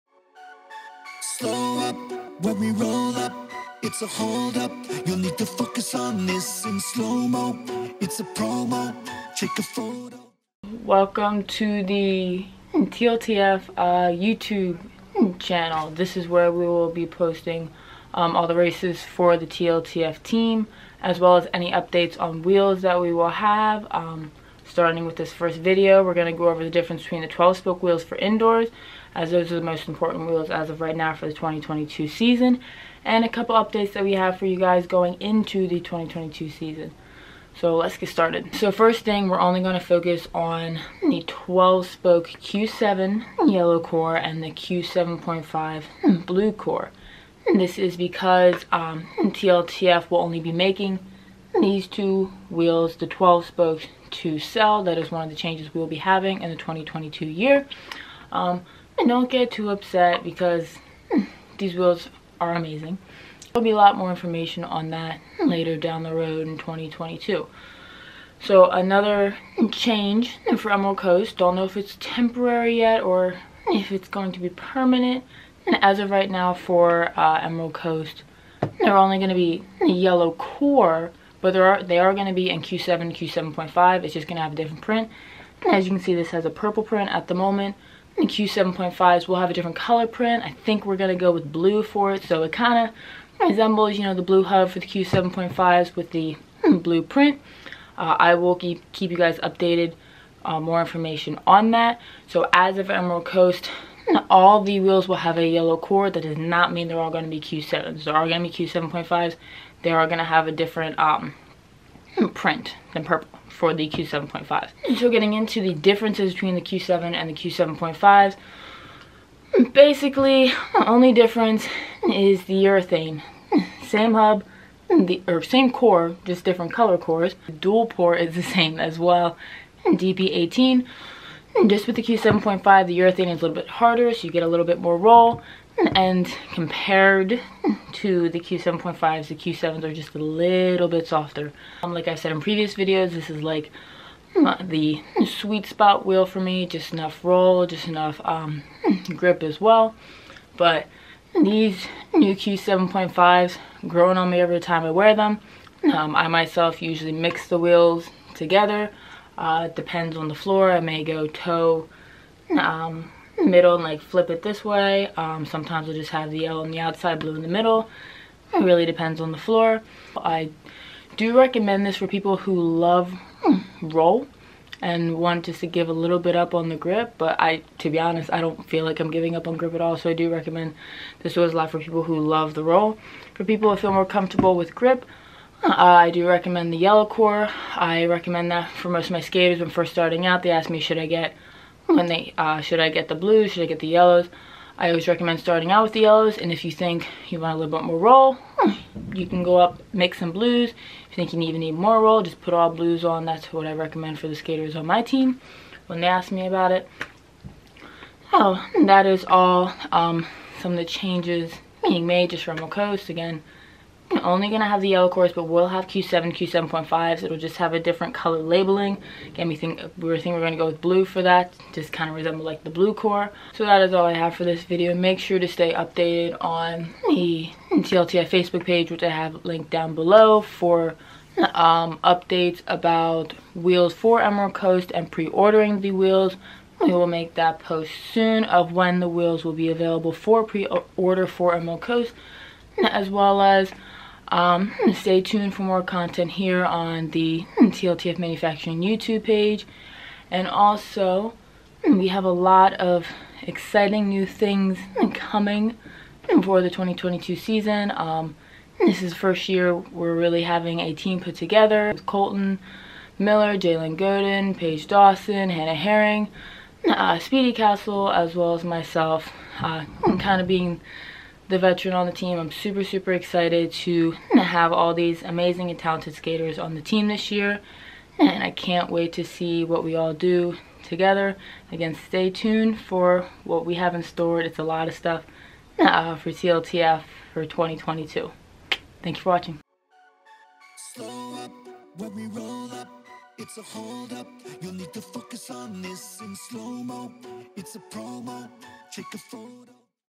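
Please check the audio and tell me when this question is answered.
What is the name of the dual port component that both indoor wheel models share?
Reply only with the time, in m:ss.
2:09.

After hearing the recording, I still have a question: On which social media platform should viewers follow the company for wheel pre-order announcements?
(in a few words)
Facebook.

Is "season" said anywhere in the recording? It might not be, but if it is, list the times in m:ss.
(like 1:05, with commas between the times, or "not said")
0:32, 0:36, 4:17.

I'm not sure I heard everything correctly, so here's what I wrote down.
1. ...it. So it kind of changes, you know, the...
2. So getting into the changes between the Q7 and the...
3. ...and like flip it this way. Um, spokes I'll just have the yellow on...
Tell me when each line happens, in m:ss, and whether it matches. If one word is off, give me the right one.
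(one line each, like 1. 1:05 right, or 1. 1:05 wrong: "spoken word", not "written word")
1. 1:32 wrong: "resembles", not "changes"
2. 1:54 wrong: "differences", not "changes"
3. 2:43 wrong: "sometimes", not "spokes".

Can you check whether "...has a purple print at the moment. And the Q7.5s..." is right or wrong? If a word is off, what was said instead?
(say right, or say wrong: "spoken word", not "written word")
right.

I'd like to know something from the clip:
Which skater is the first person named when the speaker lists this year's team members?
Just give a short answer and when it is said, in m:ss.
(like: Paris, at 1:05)
Colton Miller, at 4:22.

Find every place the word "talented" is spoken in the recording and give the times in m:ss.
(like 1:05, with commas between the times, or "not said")
4:35.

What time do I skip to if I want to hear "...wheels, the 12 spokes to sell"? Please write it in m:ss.
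0:52.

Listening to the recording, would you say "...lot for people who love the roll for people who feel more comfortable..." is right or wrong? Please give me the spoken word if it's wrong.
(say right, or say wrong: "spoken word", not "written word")
right.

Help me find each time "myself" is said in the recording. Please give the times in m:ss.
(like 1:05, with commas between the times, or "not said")
2:36, 4:28.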